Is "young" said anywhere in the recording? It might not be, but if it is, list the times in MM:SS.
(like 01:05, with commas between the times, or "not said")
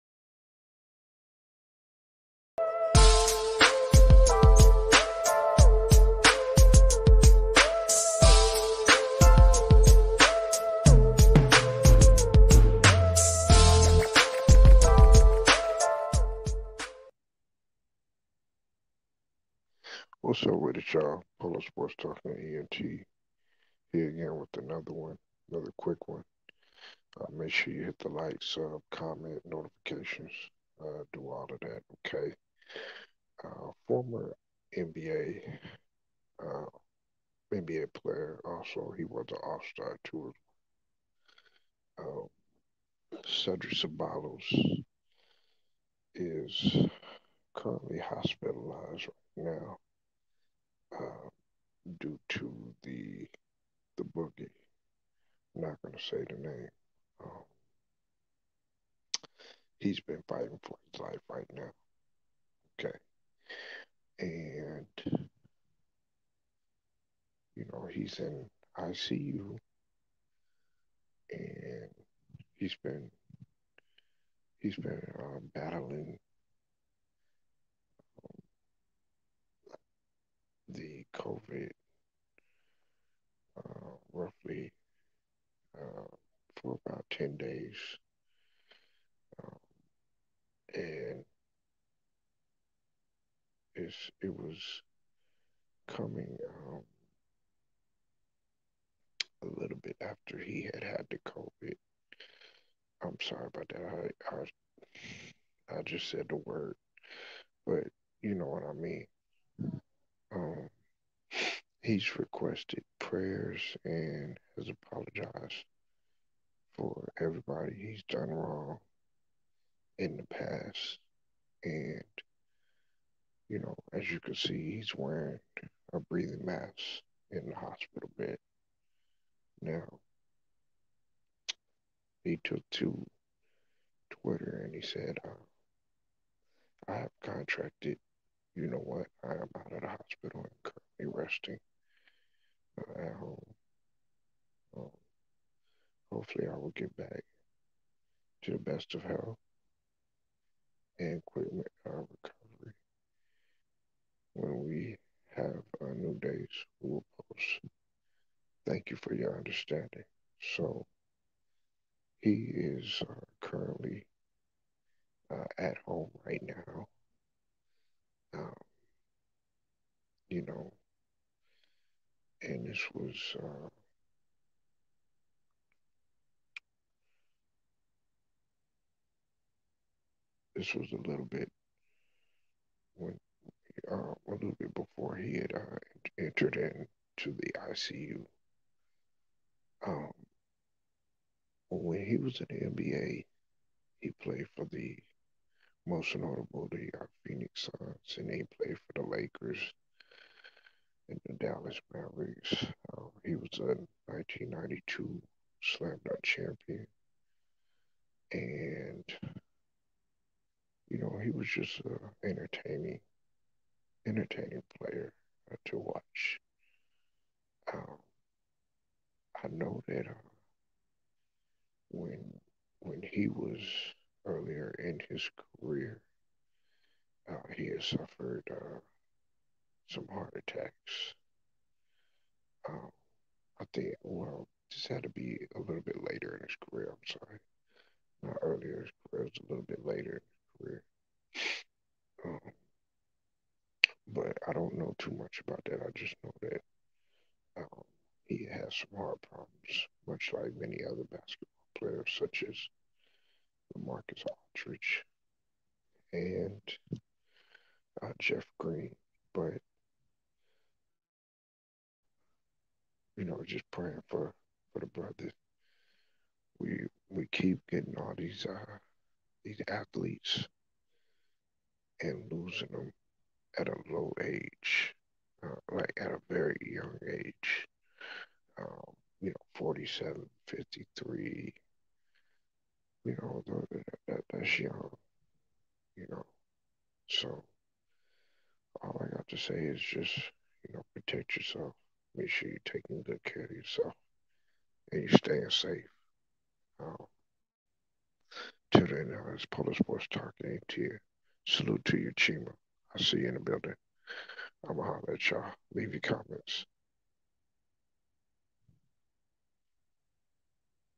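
04:36, 04:44.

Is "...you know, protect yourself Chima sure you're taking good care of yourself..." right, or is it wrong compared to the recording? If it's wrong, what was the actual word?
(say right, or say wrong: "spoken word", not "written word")
wrong: "Make", not "Chima".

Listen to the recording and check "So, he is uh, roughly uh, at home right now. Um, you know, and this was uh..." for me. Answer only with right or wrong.
wrong.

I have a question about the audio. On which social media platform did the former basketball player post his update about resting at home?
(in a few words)
Twitter.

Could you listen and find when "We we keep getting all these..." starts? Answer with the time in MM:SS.
04:26.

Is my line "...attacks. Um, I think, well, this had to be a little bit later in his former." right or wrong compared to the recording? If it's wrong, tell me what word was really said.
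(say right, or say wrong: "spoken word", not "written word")
wrong: "career", not "former".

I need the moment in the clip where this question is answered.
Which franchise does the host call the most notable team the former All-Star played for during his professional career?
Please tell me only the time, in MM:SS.
03:17.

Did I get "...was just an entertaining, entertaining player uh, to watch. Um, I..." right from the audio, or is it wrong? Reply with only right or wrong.
right.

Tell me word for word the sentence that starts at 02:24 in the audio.
Um, hopefully, I will get back to the best of health and quick our recovery.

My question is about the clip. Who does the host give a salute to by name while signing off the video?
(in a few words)
Chima.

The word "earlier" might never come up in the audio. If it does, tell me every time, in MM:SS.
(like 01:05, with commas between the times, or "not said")
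03:44, 03:58.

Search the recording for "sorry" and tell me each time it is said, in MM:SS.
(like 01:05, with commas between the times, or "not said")
01:43, 03:57.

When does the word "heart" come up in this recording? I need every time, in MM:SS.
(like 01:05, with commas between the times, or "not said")
03:50, 04:08.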